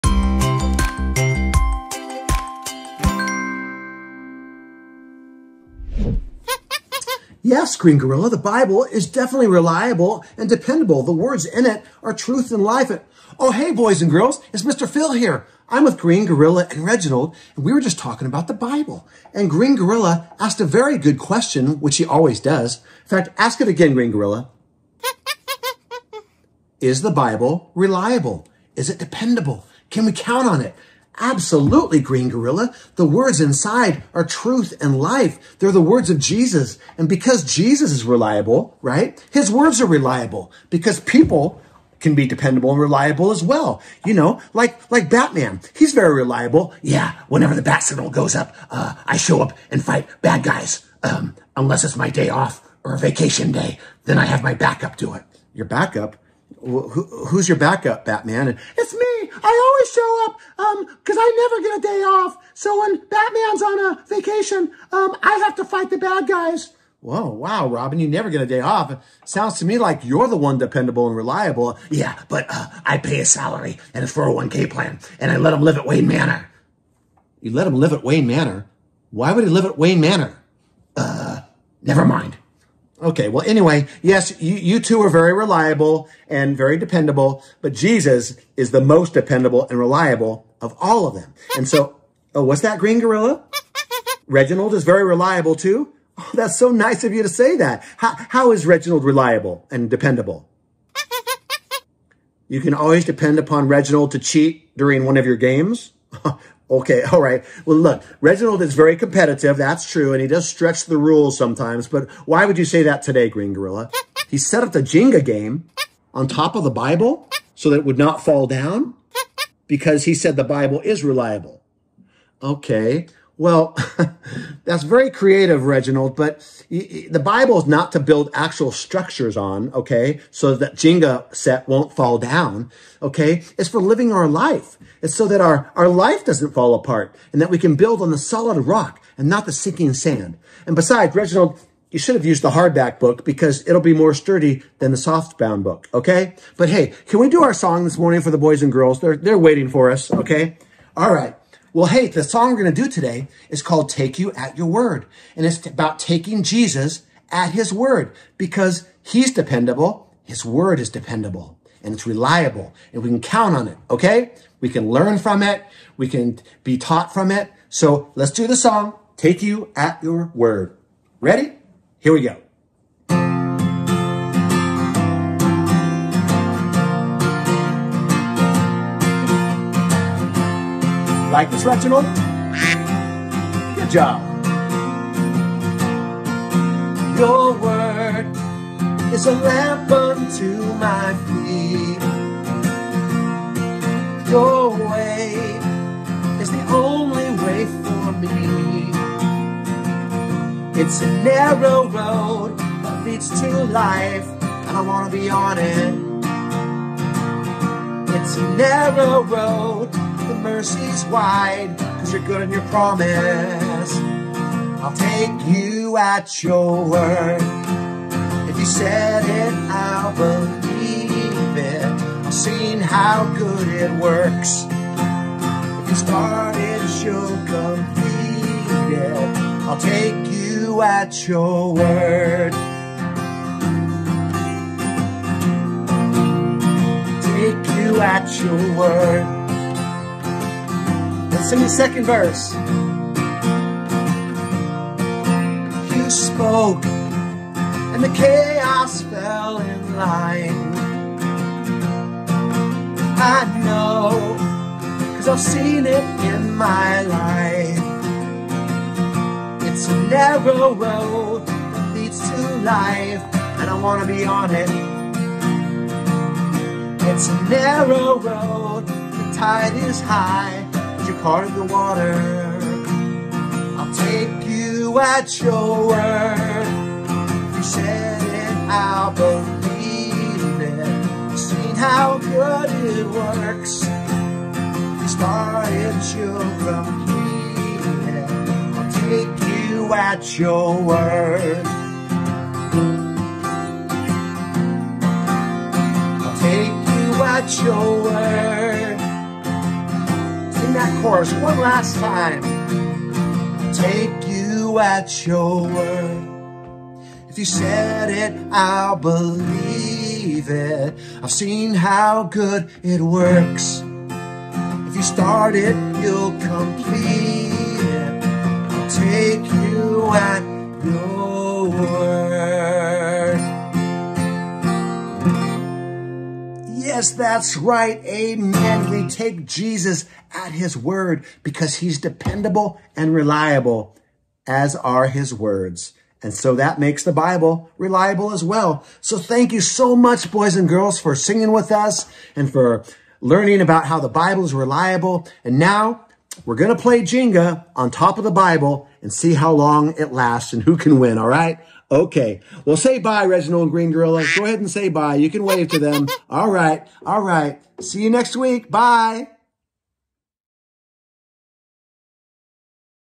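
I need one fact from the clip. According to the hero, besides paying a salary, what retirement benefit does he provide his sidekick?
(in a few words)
401k plan.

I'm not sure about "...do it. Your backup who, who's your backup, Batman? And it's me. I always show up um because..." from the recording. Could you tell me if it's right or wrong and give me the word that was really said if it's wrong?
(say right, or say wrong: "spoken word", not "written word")
right.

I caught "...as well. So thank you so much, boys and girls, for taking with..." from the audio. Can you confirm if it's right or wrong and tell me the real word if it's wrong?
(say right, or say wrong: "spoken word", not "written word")
wrong: "singing", not "taking".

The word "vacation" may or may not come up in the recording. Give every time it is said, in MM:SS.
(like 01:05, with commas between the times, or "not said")
00:52, 01:04.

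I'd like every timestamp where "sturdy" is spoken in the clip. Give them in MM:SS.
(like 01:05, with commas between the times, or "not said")
02:24.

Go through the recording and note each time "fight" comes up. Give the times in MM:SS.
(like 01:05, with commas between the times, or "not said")
00:49, 01:05.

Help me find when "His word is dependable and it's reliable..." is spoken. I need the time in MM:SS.
02:40.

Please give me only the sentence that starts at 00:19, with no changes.
And Green Gorilla asked a very good question, which he always does.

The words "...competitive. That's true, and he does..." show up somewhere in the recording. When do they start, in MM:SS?
01:48.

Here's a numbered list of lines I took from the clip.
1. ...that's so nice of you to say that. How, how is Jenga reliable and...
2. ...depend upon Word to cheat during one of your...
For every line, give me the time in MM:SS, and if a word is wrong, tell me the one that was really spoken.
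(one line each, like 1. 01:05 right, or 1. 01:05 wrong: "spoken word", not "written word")
1. 01:36 wrong: "Reginald", not "Jenga"
2. 01:43 wrong: "Reginald", not "Word".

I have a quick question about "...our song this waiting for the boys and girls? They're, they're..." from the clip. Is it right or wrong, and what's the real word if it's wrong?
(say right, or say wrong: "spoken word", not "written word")
wrong: "morning", not "waiting".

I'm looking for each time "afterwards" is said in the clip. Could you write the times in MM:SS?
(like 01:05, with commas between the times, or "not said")
not said.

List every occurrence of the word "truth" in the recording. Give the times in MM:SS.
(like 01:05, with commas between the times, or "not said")
00:12, 00:34.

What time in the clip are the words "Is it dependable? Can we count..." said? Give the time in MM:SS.
00:28.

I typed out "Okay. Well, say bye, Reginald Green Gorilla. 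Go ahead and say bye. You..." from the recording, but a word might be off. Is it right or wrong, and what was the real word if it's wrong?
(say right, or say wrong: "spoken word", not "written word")
right.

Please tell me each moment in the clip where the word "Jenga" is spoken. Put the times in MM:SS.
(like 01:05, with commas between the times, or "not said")
01:54, 02:10, 05:47.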